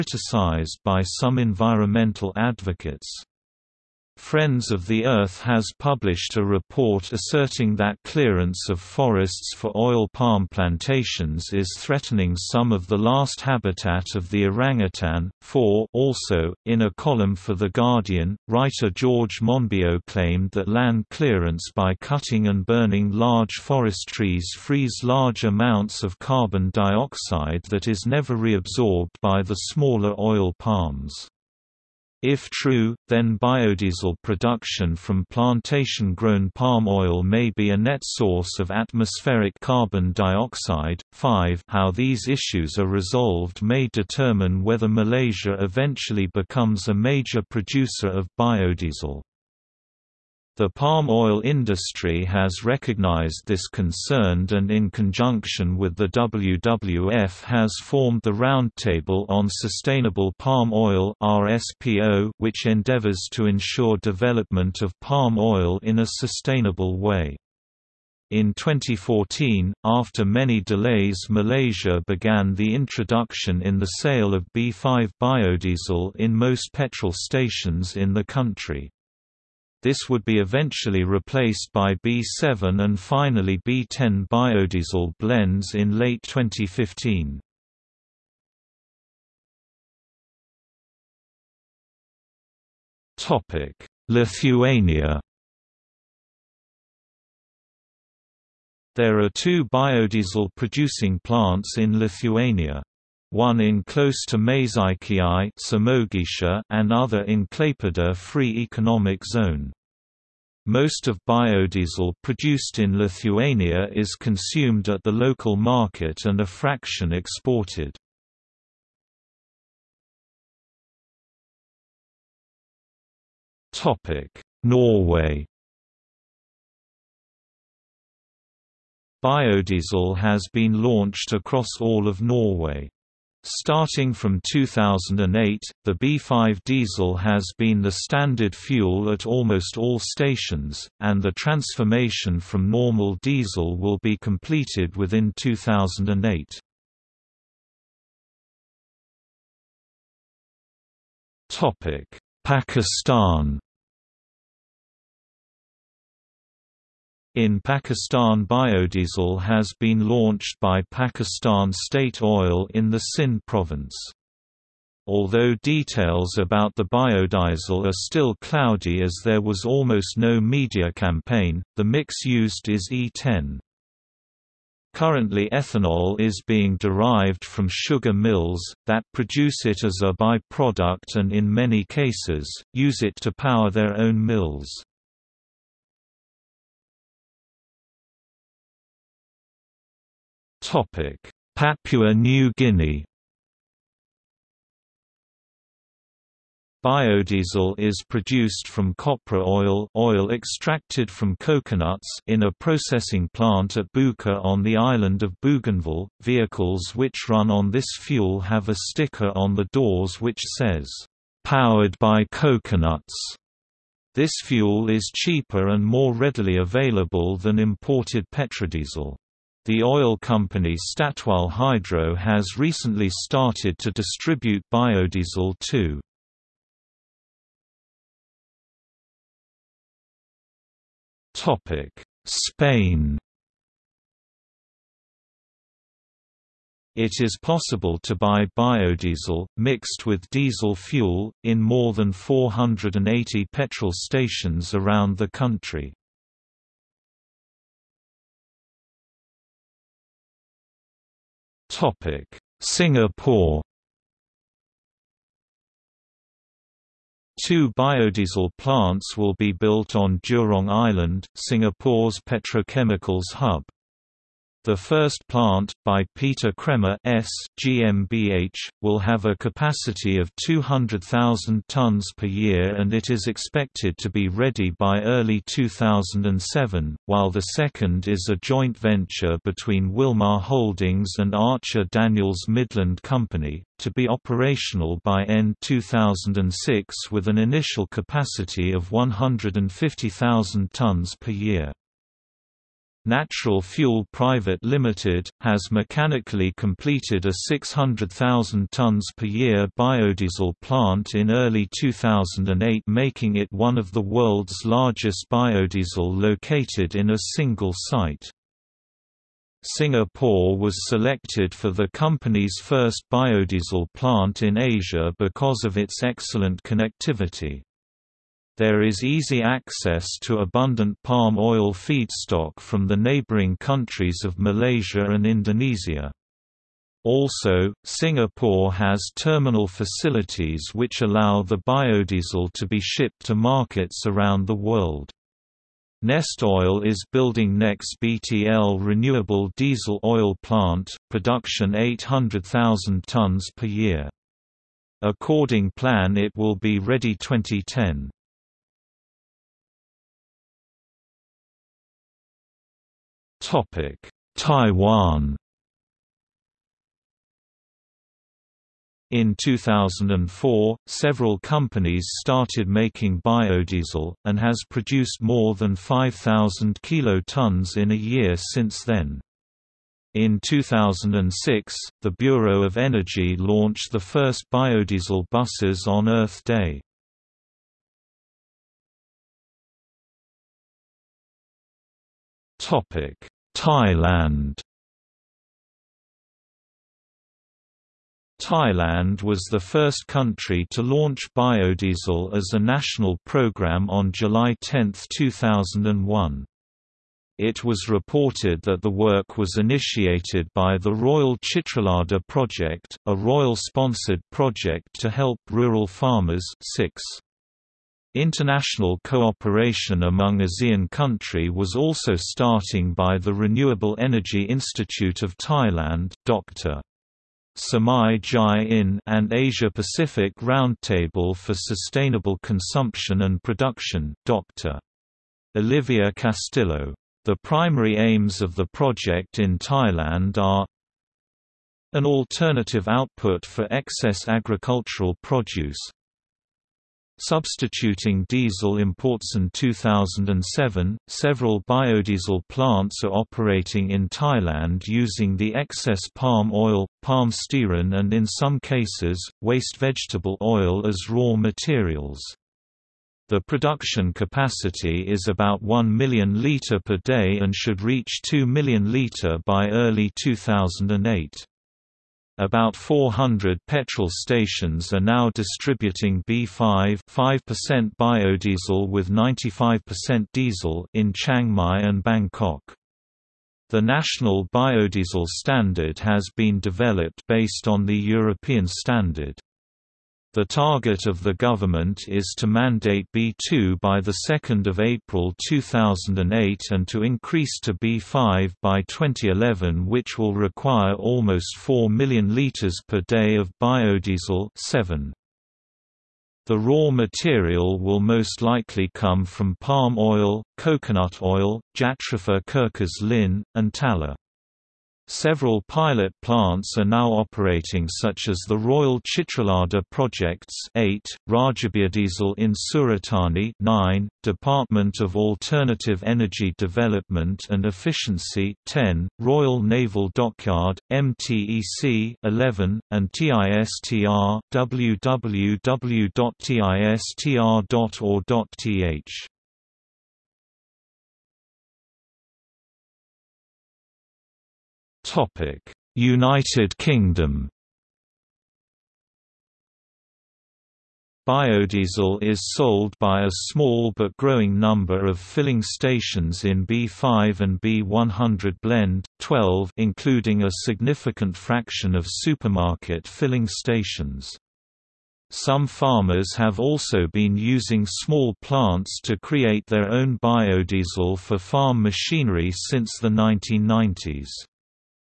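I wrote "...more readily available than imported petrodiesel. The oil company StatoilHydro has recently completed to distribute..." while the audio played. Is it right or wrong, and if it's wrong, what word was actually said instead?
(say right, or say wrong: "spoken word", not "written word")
wrong: "started", not "completed".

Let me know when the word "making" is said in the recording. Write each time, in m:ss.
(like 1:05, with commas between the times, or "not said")
5:02, 6:02.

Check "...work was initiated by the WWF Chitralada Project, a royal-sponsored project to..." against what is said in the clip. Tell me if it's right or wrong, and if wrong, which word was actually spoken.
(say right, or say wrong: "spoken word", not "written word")
wrong: "Royal", not "WWF".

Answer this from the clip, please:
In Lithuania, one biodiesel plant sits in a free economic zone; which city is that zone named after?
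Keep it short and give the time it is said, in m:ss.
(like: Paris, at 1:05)
Klaipeda, at 1:47.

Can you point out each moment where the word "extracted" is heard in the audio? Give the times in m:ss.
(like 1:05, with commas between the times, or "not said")
3:20.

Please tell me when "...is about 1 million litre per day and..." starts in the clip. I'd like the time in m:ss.
7:35.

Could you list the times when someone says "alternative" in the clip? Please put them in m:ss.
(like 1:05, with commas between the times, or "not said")
7:12, 8:35.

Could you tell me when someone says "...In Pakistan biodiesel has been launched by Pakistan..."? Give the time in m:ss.
2:37.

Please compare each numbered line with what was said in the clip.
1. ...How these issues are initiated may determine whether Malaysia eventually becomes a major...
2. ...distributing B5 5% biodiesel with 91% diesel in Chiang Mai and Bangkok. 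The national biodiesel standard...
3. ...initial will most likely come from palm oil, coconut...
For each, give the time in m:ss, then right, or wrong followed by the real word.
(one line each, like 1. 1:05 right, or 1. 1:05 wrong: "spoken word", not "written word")
1. 0:41 wrong: "resolved", not "initiated"
2. 7:45 wrong: "95", not "91"
3. 8:16 wrong: "material", not "initial".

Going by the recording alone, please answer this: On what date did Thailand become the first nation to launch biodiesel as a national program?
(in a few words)
July 10, 2001.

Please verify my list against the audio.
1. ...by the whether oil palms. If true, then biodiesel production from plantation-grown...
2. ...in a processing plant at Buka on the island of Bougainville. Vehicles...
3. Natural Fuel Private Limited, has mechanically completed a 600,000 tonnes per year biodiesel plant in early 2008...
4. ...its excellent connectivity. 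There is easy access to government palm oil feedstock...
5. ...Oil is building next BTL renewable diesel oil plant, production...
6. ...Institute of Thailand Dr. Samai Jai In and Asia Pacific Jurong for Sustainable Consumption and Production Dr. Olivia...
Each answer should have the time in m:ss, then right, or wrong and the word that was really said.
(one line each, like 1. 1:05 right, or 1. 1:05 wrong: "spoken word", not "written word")
1. 0:29 wrong: "smaller", not "whether"
2. 3:22 right
3. 4:53 right
4. 5:15 wrong: "abundant", not "government"
5. 5:36 right
6. 6:54 wrong: "Roundtable", not "Jurong".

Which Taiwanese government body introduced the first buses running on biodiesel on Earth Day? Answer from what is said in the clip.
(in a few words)
Bureau of Energy.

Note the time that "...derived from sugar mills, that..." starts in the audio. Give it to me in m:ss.
2:56.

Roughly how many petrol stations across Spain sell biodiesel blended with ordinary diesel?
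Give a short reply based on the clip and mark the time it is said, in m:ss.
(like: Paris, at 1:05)
480, at 4:02.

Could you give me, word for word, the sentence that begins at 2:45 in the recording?
Although details about the biodiesel are still cloudy as there was almost no media campaign, the mix used is E10.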